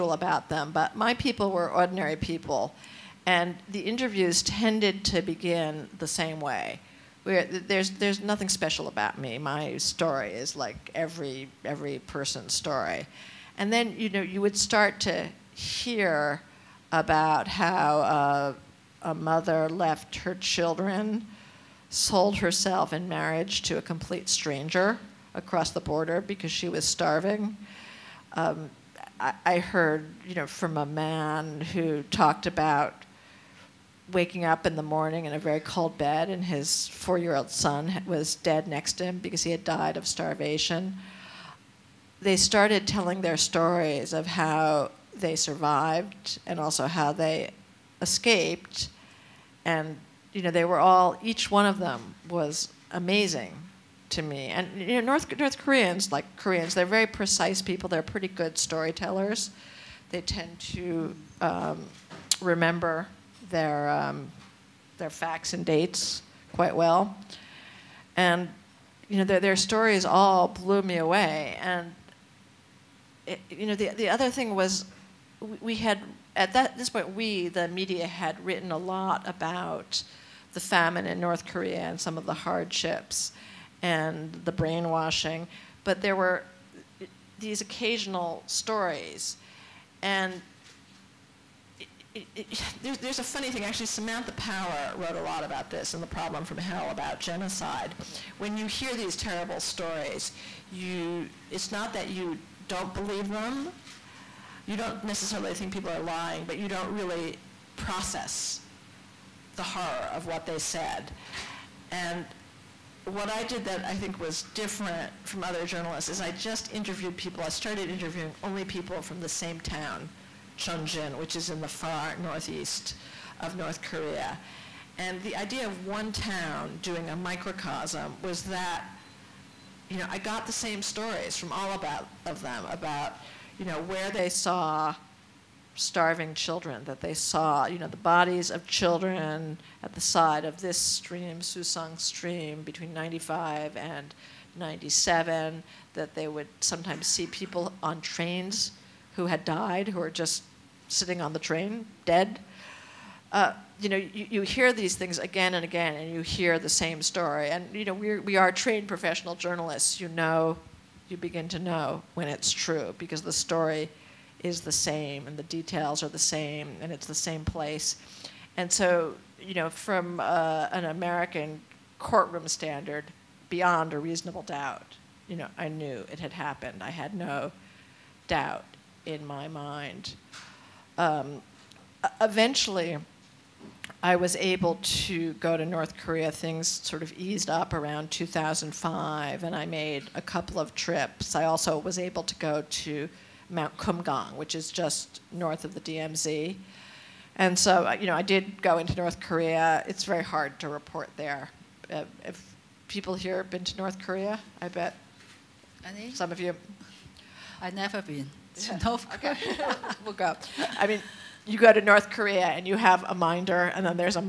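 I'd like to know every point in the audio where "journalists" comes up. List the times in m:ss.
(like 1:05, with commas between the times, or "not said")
1:55, 2:39.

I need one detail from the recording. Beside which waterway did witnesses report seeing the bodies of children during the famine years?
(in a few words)
Susong stream.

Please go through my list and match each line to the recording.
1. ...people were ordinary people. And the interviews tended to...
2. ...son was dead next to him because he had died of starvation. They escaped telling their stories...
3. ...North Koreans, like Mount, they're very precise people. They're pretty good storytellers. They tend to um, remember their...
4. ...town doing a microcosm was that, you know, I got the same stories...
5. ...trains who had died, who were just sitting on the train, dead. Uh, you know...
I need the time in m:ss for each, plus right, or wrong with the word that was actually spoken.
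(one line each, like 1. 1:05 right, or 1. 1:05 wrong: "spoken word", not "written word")
1. 0:01 right
2. 0:37 wrong: "started", not "escaped"
3. 0:55 wrong: "Koreans", not "Mount"
4. 2:06 right
5. 2:28 right.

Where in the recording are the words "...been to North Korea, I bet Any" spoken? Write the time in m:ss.
3:23.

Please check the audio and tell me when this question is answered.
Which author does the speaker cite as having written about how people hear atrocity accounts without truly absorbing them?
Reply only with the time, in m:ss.
1:33.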